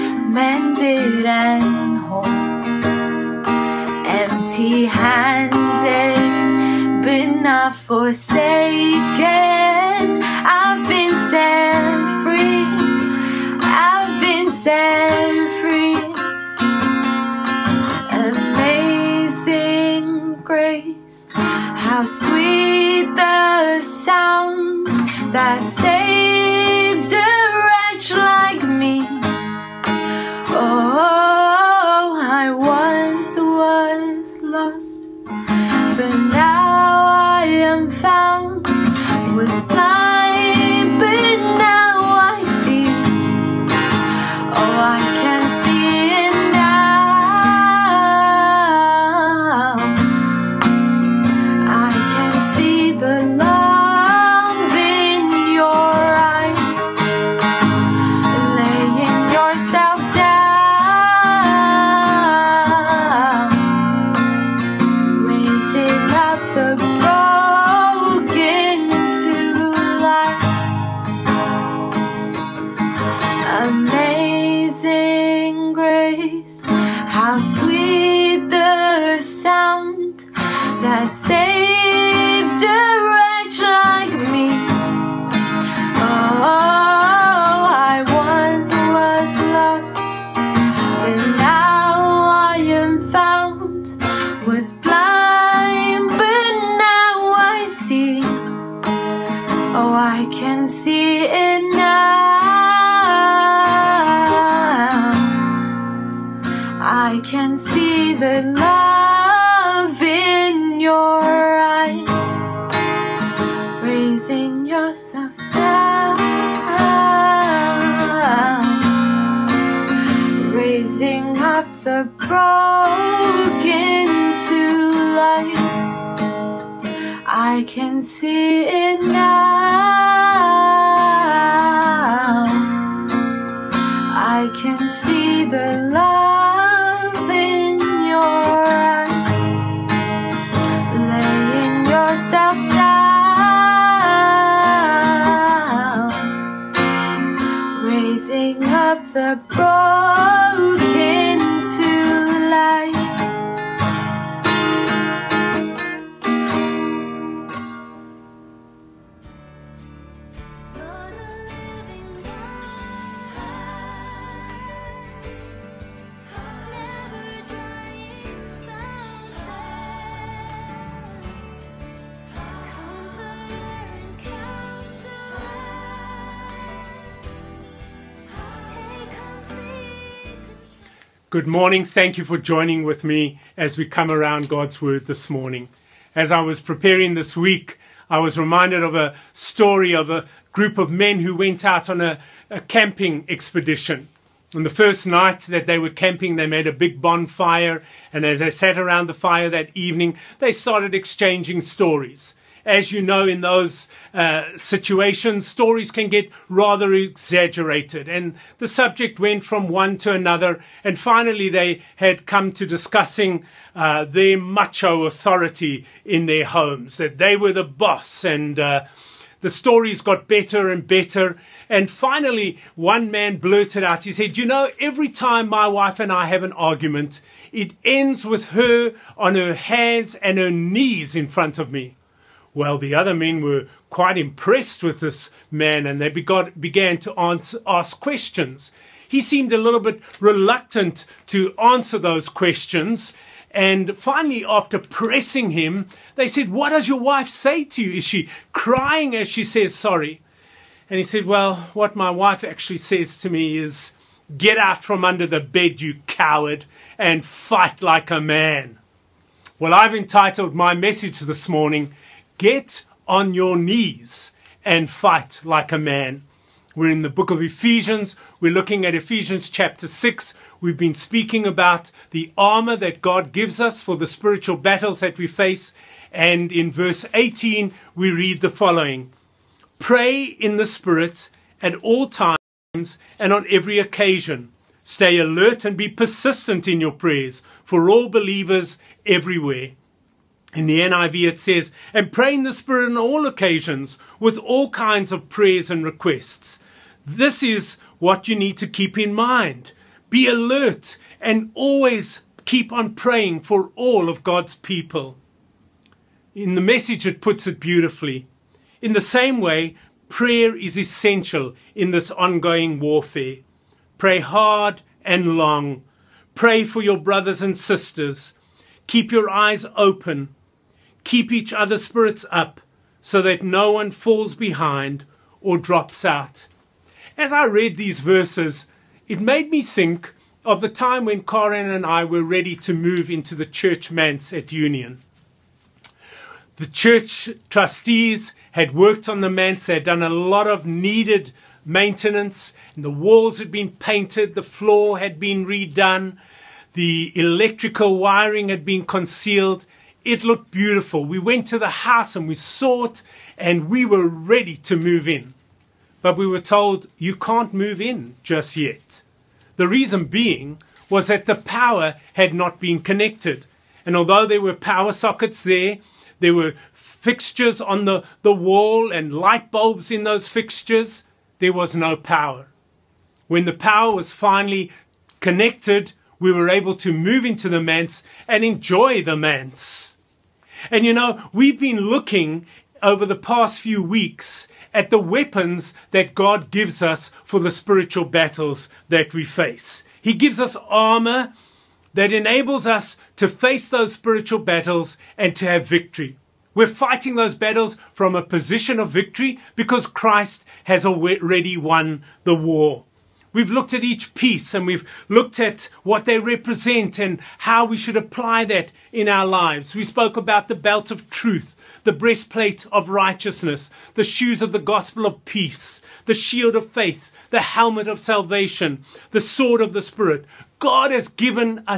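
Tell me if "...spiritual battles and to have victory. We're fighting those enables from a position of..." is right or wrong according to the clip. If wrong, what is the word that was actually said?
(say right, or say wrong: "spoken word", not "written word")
wrong: "battles", not "enables".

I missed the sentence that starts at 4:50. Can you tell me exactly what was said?
In the NIV it says, and pray in the Spirit on all occasions with all kinds of prayers and requests.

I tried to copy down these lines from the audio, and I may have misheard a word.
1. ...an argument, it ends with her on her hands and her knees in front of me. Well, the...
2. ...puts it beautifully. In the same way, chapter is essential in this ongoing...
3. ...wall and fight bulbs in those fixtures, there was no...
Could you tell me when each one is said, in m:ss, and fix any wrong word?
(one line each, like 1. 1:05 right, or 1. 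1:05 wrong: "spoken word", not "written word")
1. 3:46 right
2. 5:07 wrong: "prayer", not "chapter"
3. 6:08 wrong: "light", not "fight".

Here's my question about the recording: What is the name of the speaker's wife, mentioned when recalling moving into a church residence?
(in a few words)
Karen.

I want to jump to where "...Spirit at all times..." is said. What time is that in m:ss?
4:40.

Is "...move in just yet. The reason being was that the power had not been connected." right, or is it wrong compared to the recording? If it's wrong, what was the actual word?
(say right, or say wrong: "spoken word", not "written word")
right.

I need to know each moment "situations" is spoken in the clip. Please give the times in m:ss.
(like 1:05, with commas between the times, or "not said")
3:24.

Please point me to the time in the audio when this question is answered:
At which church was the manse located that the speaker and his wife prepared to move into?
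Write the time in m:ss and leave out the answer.
5:34.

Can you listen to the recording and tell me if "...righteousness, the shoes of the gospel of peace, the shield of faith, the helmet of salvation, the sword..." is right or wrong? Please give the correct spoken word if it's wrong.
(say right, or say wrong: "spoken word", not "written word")
right.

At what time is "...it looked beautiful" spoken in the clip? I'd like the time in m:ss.
5:50.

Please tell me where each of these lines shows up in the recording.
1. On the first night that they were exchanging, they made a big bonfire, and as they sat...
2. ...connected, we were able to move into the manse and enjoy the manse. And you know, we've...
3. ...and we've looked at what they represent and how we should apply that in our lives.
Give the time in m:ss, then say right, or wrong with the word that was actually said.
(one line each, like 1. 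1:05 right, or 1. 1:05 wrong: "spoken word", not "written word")
1. 3:14 wrong: "camping", not "exchanging"
2. 6:15 right
3. 6:44 right.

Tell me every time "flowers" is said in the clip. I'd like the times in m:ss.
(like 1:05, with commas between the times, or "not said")
not said.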